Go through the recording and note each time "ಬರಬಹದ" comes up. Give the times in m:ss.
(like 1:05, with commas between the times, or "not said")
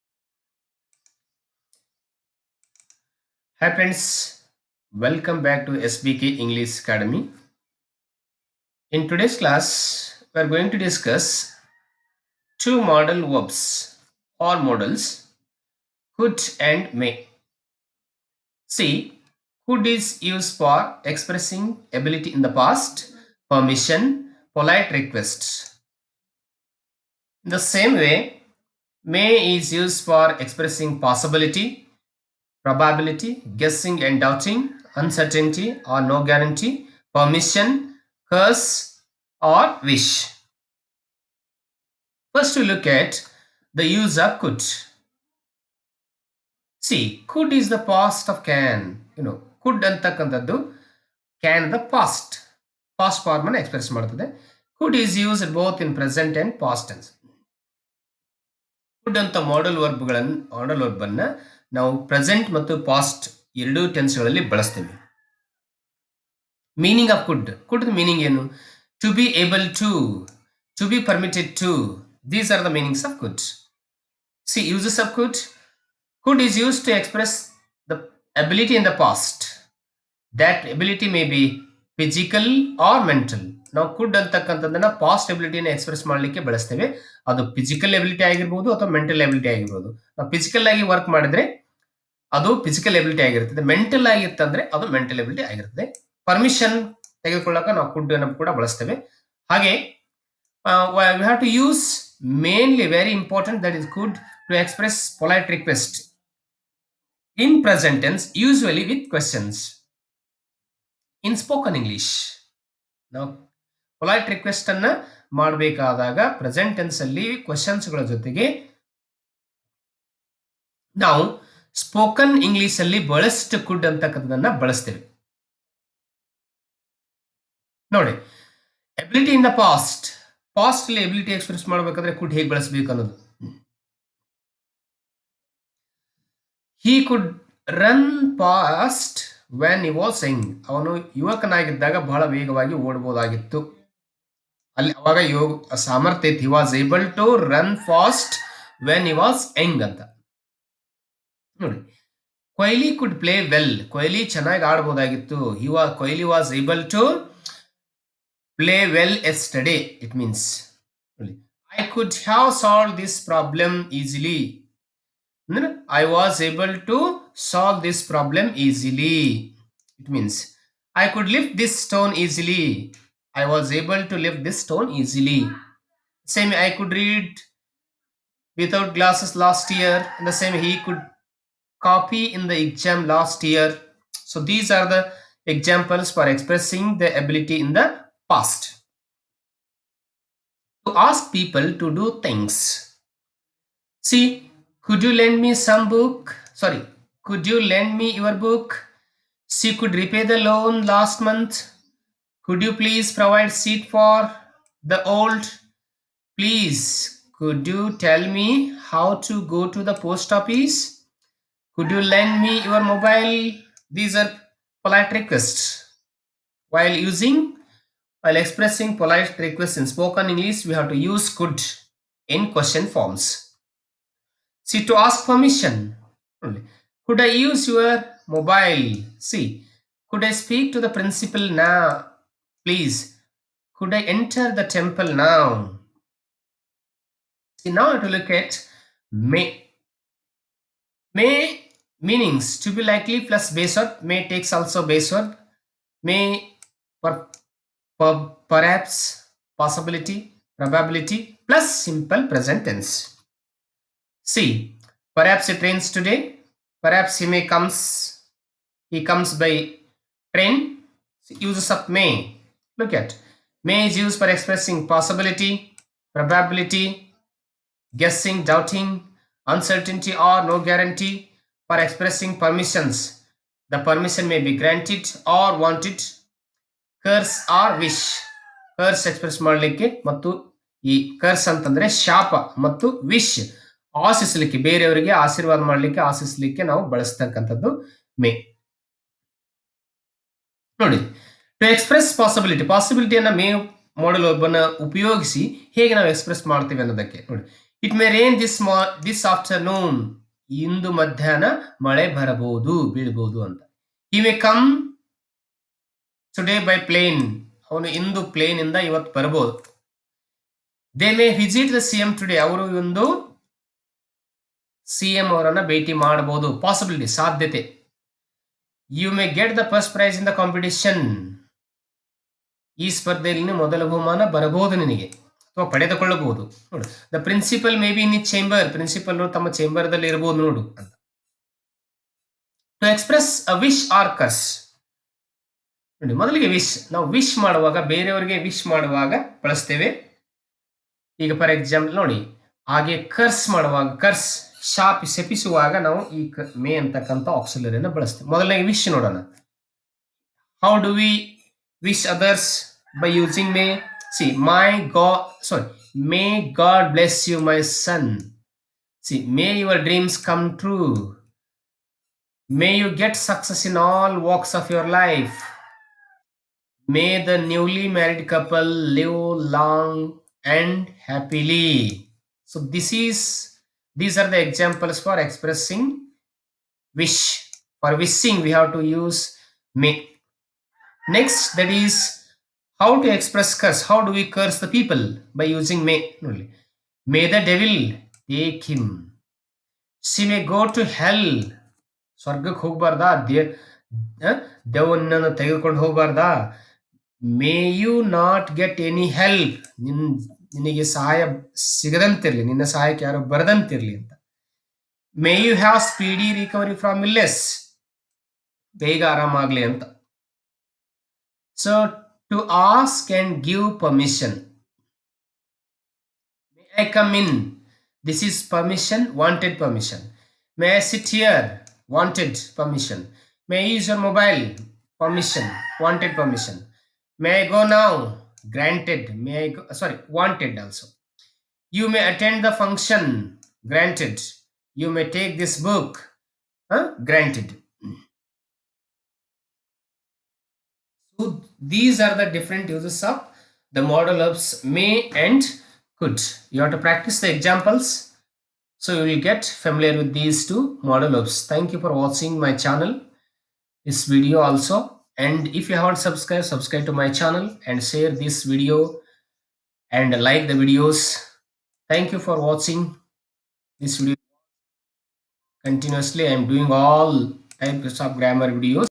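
5:02, 5:09, 5:24.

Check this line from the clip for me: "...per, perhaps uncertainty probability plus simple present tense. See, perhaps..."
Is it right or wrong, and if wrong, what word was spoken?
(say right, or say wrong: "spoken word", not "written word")
wrong: "possibility", not "uncertainty".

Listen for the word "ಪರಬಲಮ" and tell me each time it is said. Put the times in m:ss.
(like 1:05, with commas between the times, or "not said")
2:43, 2:48.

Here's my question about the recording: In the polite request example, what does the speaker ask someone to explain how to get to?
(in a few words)
the post office.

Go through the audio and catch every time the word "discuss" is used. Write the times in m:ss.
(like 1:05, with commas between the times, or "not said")
0:10.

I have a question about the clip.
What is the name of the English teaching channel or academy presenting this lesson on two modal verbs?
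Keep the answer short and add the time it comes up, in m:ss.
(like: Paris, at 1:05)
SBK English Academy, at 0:05.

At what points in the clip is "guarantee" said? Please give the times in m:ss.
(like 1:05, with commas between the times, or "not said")
0:36, 4:30.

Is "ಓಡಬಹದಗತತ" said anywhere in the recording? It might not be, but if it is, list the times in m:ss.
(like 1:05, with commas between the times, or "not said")
2:22.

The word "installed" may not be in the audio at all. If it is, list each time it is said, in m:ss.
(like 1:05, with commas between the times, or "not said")
not said.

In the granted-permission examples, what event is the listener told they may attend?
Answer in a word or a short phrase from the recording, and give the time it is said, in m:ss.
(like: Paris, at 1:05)
the function, at 7:12.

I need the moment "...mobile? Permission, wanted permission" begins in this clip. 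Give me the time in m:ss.
7:03.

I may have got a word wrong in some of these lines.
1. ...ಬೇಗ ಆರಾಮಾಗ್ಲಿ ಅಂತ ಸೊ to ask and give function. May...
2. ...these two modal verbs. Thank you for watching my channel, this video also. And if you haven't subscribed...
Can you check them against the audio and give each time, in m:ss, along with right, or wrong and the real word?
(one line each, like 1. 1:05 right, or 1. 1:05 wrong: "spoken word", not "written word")
1. 6:48 wrong: "permission", not "function"
2. 7:30 right.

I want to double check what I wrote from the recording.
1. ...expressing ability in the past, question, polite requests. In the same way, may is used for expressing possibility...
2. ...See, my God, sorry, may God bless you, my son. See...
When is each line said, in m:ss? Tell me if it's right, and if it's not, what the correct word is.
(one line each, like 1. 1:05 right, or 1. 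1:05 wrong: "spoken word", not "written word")
1. 0:21 wrong: "permission", not "question"
2. 5:54 right.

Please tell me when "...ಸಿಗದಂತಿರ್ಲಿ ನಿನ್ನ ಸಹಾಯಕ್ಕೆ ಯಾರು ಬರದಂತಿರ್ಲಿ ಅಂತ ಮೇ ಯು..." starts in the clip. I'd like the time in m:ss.
6:41.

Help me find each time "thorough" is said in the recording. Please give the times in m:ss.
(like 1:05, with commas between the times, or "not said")
not said.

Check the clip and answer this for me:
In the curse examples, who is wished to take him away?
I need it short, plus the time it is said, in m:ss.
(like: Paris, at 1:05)
the devil, at 6:27.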